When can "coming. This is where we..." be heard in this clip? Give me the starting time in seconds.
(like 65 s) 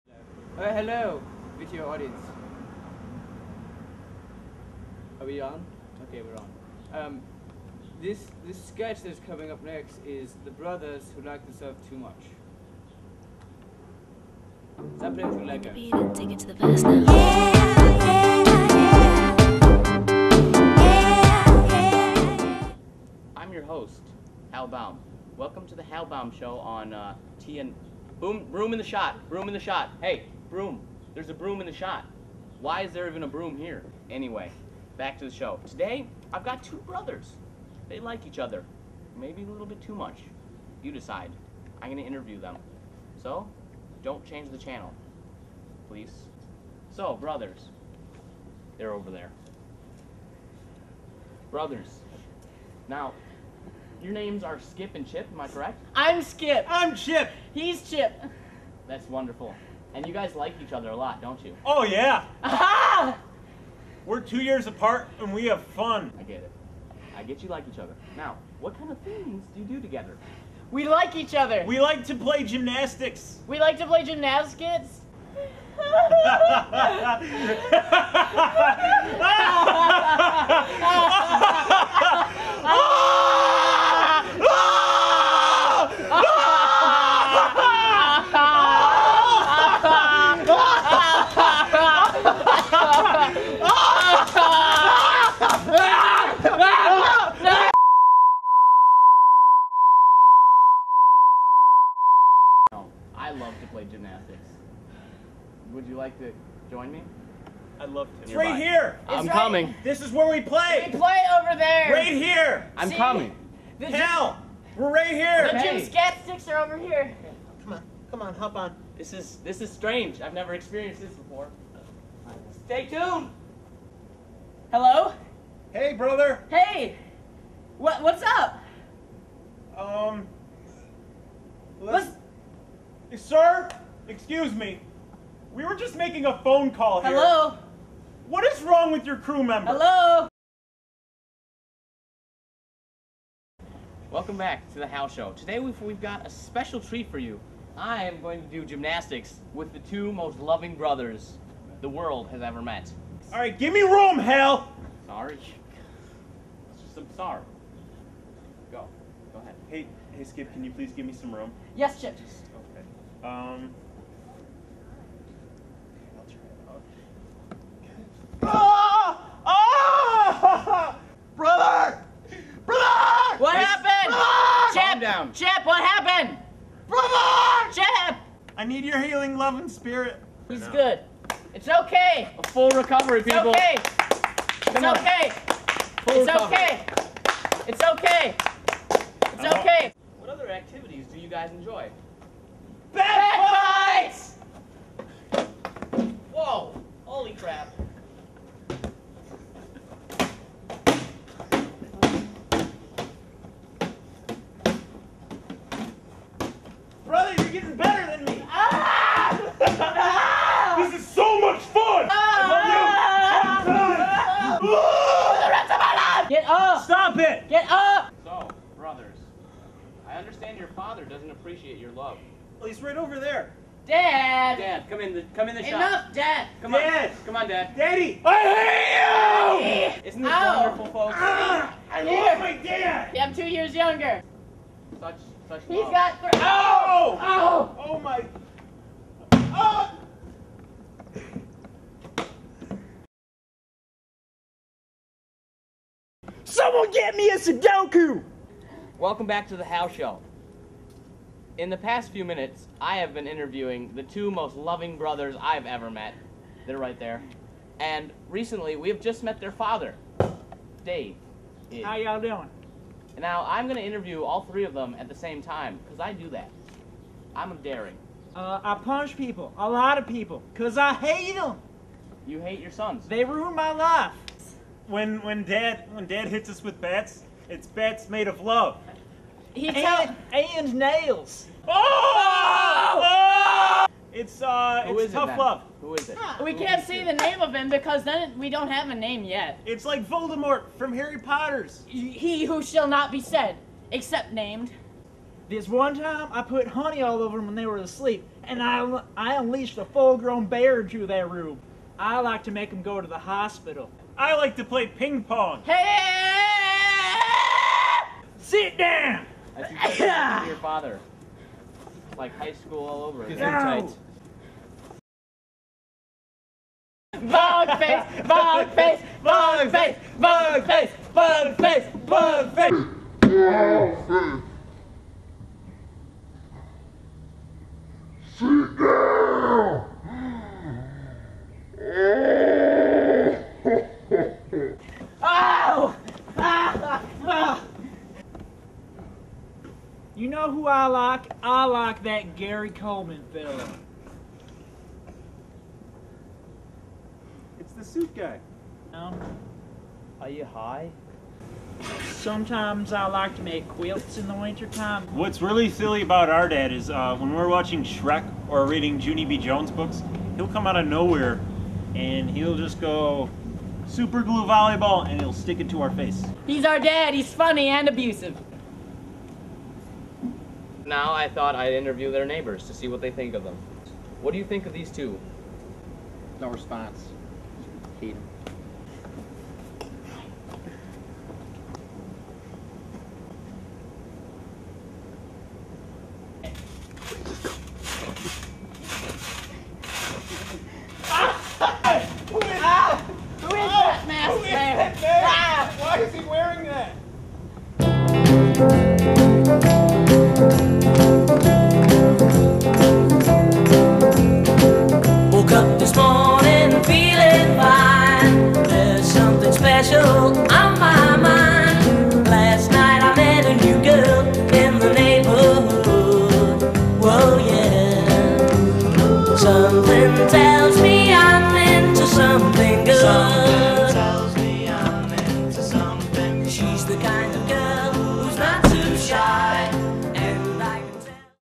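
109 s.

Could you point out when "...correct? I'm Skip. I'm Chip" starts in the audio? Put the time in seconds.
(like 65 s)
55 s.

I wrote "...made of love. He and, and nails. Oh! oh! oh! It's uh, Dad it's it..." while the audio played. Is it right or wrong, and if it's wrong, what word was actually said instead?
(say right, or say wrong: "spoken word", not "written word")
wrong: "Who", not "Dad".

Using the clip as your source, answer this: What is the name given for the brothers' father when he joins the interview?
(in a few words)
Dave.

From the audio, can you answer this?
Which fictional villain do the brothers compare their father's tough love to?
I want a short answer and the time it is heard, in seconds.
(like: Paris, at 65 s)
Voldemort, at 290 s.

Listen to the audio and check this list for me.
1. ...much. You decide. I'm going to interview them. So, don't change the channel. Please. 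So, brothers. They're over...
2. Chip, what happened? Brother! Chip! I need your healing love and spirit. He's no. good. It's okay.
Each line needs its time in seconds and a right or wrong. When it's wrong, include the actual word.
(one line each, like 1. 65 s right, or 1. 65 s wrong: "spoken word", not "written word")
1. 39 s right
2. 175 s right.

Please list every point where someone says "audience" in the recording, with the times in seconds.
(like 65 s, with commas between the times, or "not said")
1 s.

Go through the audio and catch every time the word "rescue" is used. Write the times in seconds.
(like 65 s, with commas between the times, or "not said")
not said.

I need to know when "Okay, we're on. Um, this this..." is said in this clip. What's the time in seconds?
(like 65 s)
6 s.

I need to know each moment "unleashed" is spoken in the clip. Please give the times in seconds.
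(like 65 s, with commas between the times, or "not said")
299 s.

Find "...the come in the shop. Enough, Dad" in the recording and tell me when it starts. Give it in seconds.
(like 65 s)
225 s.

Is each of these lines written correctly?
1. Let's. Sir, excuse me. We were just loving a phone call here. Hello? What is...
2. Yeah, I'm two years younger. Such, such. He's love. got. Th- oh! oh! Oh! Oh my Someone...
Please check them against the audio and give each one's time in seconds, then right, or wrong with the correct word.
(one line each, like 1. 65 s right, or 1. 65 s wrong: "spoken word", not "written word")
1. 131 s wrong: "making", not "loving"
2. 233 s right.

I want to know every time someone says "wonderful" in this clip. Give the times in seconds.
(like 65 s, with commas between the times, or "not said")
59 s, 230 s.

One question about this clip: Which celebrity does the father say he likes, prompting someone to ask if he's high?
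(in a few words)
Gary Coleman.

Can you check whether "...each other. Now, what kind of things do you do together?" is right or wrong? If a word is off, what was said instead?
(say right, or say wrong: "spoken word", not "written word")
right.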